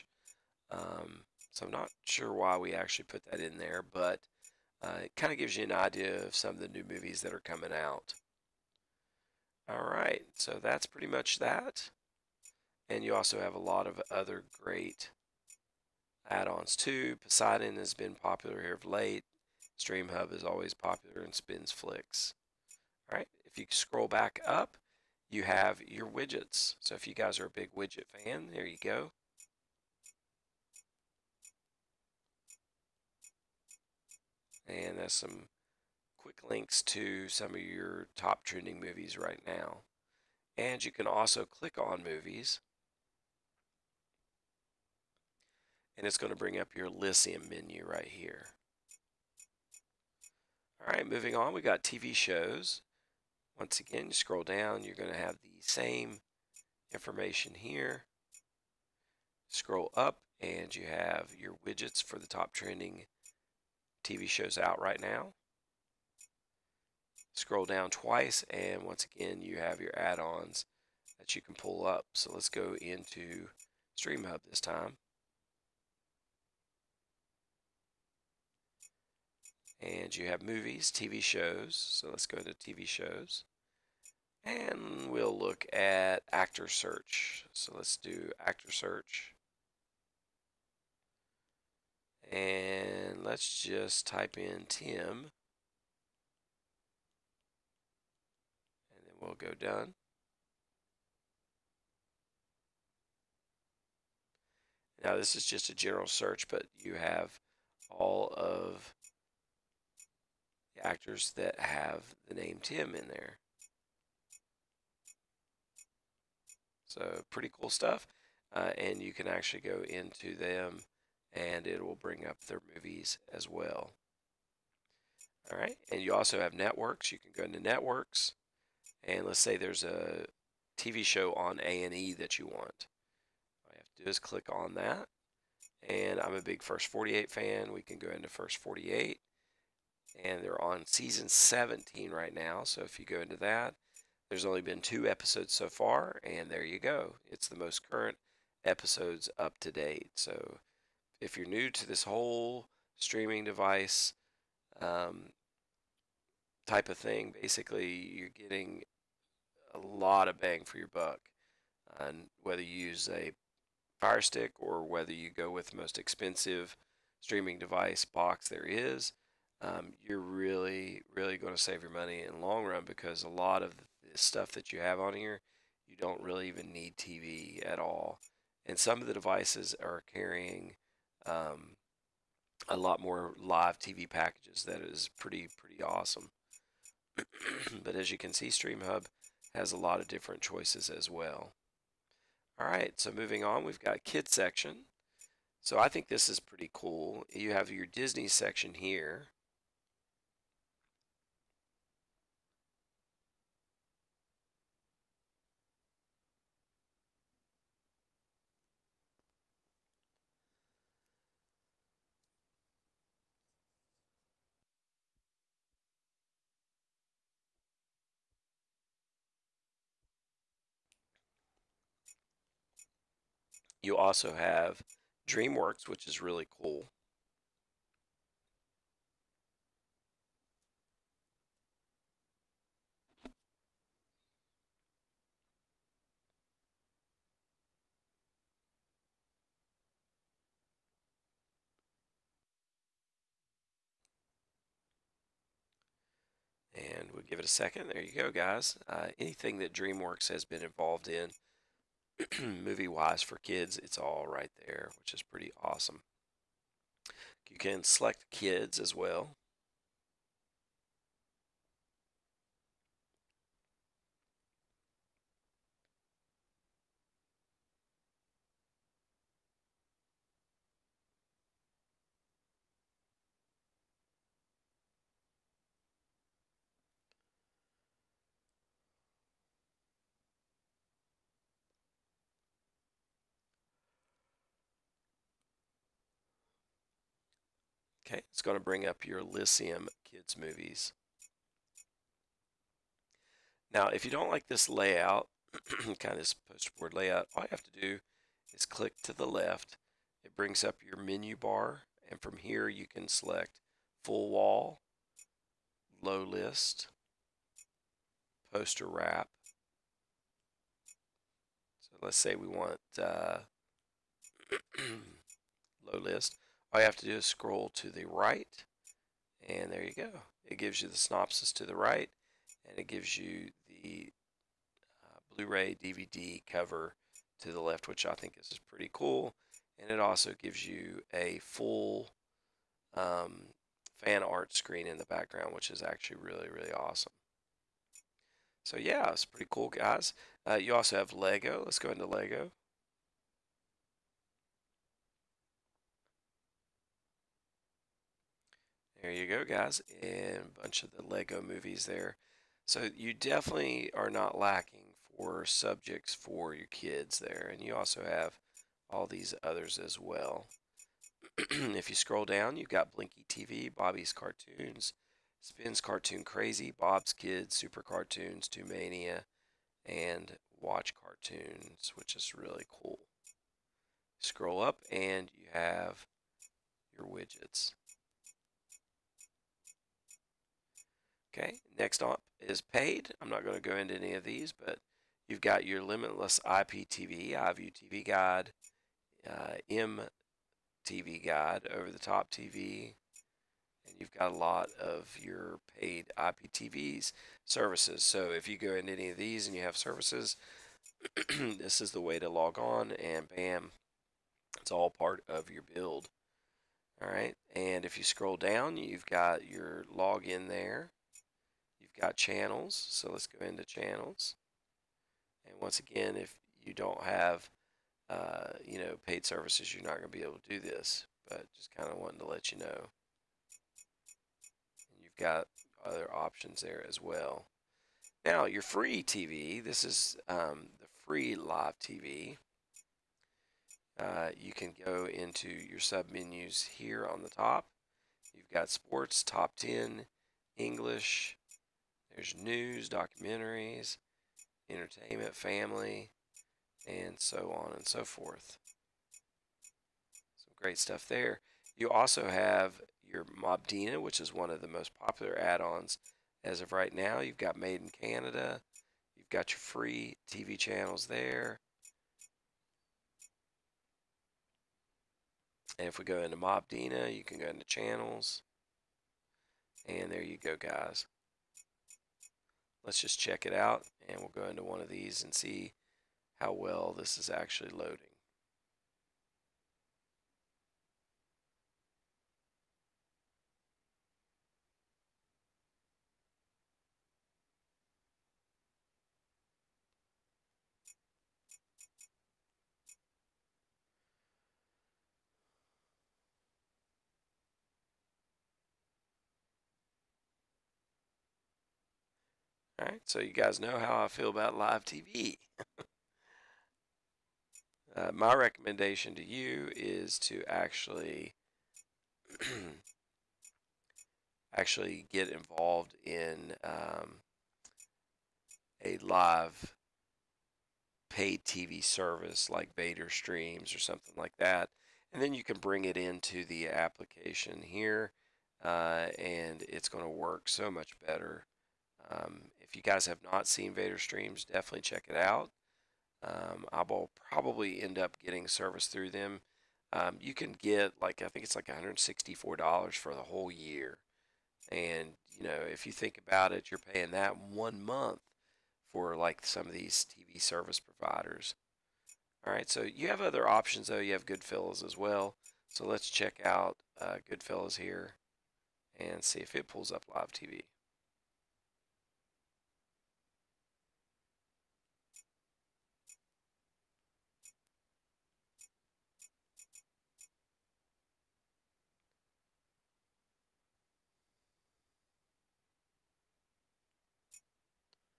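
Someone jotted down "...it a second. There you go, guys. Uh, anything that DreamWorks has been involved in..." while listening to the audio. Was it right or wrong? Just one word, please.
right.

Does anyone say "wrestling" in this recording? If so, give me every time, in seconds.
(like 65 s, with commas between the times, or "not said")
not said.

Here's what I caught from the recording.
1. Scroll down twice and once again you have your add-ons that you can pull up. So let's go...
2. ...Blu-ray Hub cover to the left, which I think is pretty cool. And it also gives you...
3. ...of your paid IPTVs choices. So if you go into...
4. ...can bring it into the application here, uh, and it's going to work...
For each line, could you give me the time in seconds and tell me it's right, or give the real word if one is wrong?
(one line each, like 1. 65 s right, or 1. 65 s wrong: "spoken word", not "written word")
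1. 67 s right
2. 325 s wrong: "DVD", not "Hub"
3. 394 s wrong: "services", not "choices"
4. 525 s right.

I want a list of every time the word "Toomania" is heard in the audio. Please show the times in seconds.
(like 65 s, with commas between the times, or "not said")
368 s.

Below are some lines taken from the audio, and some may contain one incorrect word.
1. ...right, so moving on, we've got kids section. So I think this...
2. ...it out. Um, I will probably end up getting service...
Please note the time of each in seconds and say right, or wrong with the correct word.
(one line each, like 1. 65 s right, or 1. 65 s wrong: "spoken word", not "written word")
1. 192 s right
2. 535 s right.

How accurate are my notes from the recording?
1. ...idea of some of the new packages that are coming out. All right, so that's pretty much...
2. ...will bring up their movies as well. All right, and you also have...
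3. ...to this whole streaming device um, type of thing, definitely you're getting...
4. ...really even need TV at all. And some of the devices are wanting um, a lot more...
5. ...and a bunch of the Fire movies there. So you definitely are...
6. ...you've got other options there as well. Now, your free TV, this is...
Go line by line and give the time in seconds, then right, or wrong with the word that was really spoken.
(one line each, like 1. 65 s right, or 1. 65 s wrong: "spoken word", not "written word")
1. 5 s wrong: "movies", not "packages"
2. 121 s right
3. 151 s wrong: "basically", not "definitely"
4. 176 s wrong: "carrying", not "wanting"
5. 350 s wrong: "Lego", not "Fire"
6. 425 s right.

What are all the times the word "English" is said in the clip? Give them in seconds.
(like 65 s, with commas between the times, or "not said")
440 s.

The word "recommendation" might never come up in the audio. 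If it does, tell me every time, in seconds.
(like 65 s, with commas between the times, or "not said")
508 s.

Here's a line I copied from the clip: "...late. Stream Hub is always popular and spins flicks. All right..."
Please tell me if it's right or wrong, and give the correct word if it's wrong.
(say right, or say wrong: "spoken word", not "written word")
right.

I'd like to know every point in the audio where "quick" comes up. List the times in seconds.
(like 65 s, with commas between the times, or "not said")
36 s.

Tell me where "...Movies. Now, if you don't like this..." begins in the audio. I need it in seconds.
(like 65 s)
290 s.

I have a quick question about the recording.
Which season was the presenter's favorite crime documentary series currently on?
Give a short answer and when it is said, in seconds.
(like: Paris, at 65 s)
17, at 140 s.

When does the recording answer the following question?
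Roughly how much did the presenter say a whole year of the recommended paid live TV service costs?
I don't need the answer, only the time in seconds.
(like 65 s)
541 s.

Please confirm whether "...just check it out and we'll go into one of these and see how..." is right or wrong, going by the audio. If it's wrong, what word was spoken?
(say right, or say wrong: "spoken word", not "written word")
right.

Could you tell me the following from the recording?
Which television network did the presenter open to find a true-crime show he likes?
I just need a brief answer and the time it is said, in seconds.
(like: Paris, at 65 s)
A&E, at 131 s.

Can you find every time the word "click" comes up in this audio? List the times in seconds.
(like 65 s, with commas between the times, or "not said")
41 s, 134 s, 298 s.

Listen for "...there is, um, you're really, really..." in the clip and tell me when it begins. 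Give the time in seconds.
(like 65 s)
168 s.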